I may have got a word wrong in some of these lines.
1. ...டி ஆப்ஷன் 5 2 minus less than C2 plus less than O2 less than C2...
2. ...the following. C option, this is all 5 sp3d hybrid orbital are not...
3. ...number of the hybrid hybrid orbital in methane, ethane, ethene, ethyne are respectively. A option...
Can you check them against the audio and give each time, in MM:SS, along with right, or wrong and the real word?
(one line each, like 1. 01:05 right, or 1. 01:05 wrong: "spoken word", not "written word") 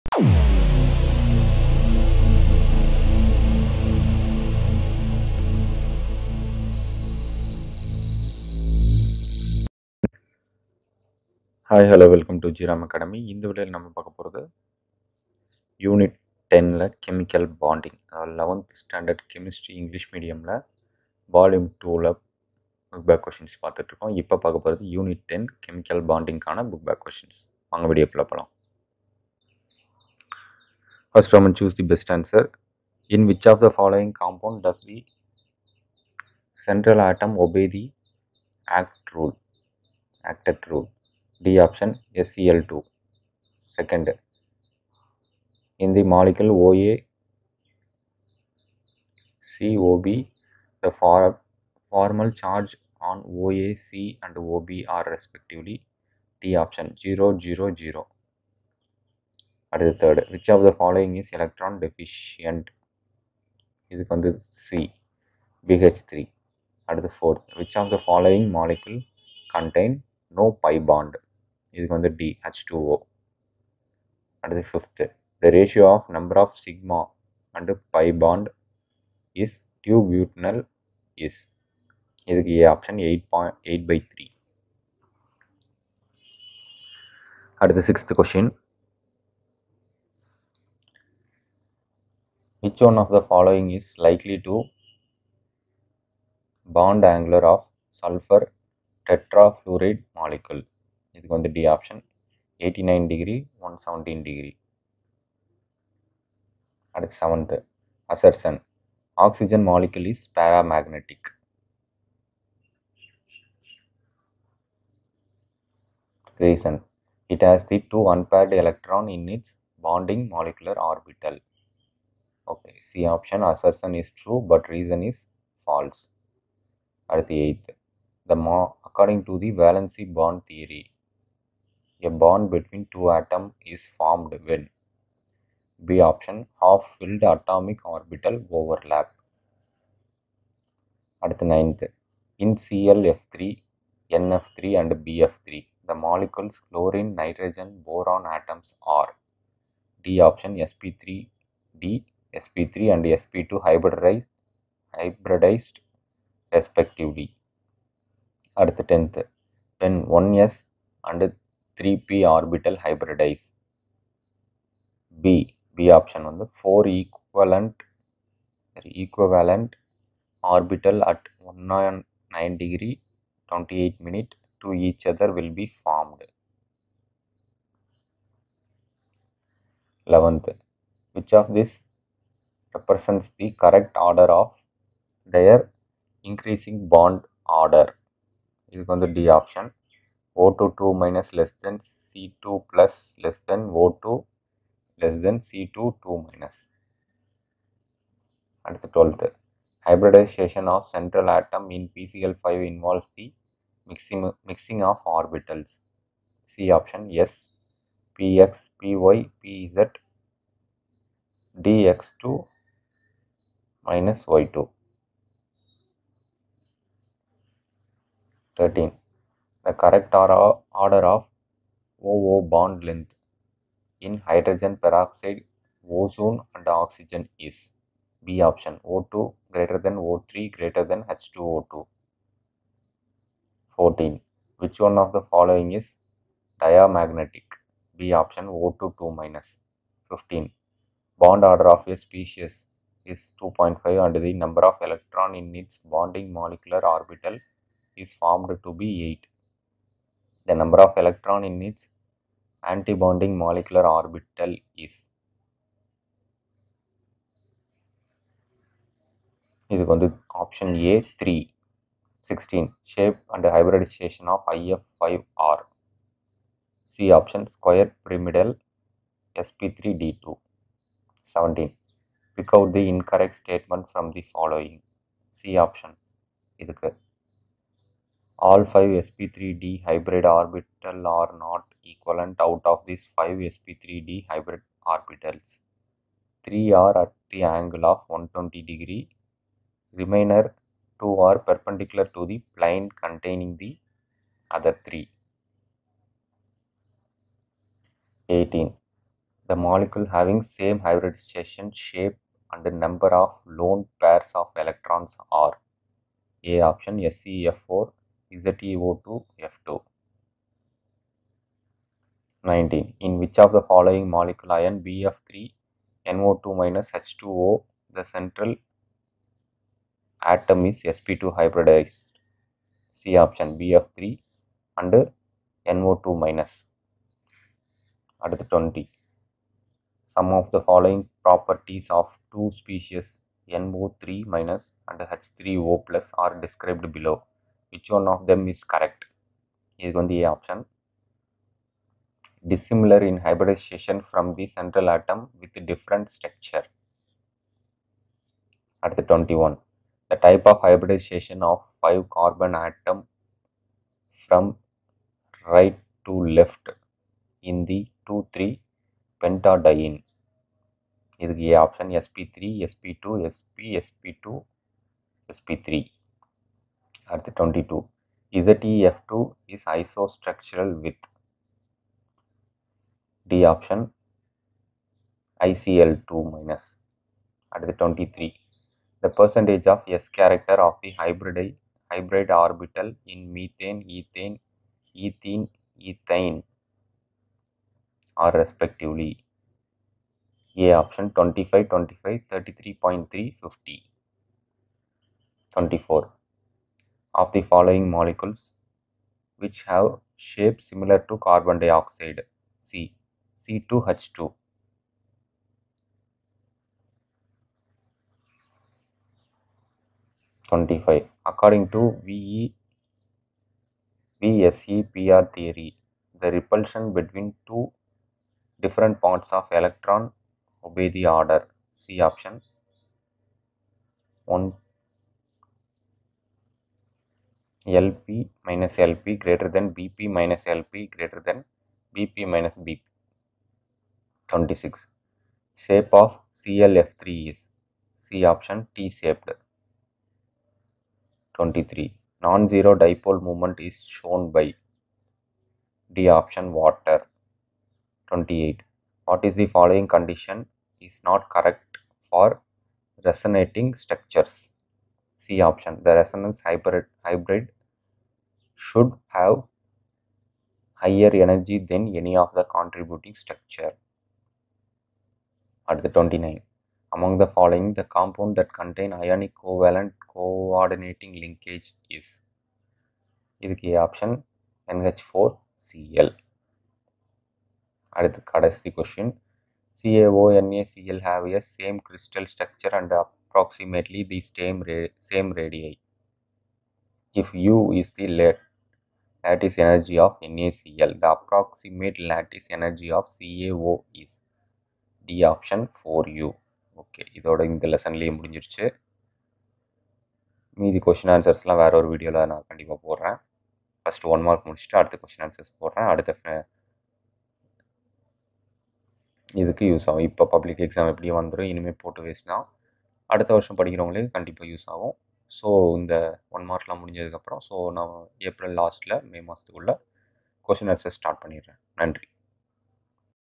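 1. 03:09 wrong: "0", not "5"
2. 04:34 right
3. 06:20 wrong: "character", not "number".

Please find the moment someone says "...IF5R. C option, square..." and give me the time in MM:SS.
04:24.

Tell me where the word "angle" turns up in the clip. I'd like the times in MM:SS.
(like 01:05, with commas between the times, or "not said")
01:37, 04:47.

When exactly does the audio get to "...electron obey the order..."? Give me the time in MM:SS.
06:59.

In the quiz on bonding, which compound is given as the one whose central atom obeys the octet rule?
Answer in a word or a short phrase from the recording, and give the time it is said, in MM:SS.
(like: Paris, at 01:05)
SCl2, at 00:42.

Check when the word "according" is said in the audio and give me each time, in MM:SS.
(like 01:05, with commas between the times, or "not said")
02:08, 06:51.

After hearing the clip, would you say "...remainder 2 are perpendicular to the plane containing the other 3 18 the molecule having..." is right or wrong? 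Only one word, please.
right.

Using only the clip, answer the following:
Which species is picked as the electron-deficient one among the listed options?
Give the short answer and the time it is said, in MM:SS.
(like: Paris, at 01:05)
BH3, at 01:05.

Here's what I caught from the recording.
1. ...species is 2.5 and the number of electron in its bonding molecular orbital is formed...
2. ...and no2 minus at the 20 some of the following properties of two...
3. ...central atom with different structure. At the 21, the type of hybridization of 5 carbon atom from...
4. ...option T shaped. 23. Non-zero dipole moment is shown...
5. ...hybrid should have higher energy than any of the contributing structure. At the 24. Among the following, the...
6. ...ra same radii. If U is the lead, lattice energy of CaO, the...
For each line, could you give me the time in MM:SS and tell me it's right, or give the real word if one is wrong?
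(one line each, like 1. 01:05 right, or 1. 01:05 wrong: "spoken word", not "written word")
1. 04:01 right
2. 05:24 right
3. 05:44 right
4. 07:18 right
5. 07:37 wrong: "29", not "24"
6. 08:04 wrong: "NaCl", not "CaO".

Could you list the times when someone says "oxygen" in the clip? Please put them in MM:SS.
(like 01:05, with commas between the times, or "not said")
01:49, 03:46.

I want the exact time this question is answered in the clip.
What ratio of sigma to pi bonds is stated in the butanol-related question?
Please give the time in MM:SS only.
01:22.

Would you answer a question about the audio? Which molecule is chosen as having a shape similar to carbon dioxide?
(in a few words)
C2H2.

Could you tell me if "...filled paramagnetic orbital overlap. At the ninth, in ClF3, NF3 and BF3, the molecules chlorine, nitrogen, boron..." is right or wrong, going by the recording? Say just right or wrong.
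wrong.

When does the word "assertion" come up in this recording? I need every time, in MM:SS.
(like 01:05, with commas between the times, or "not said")
01:48, 02:03.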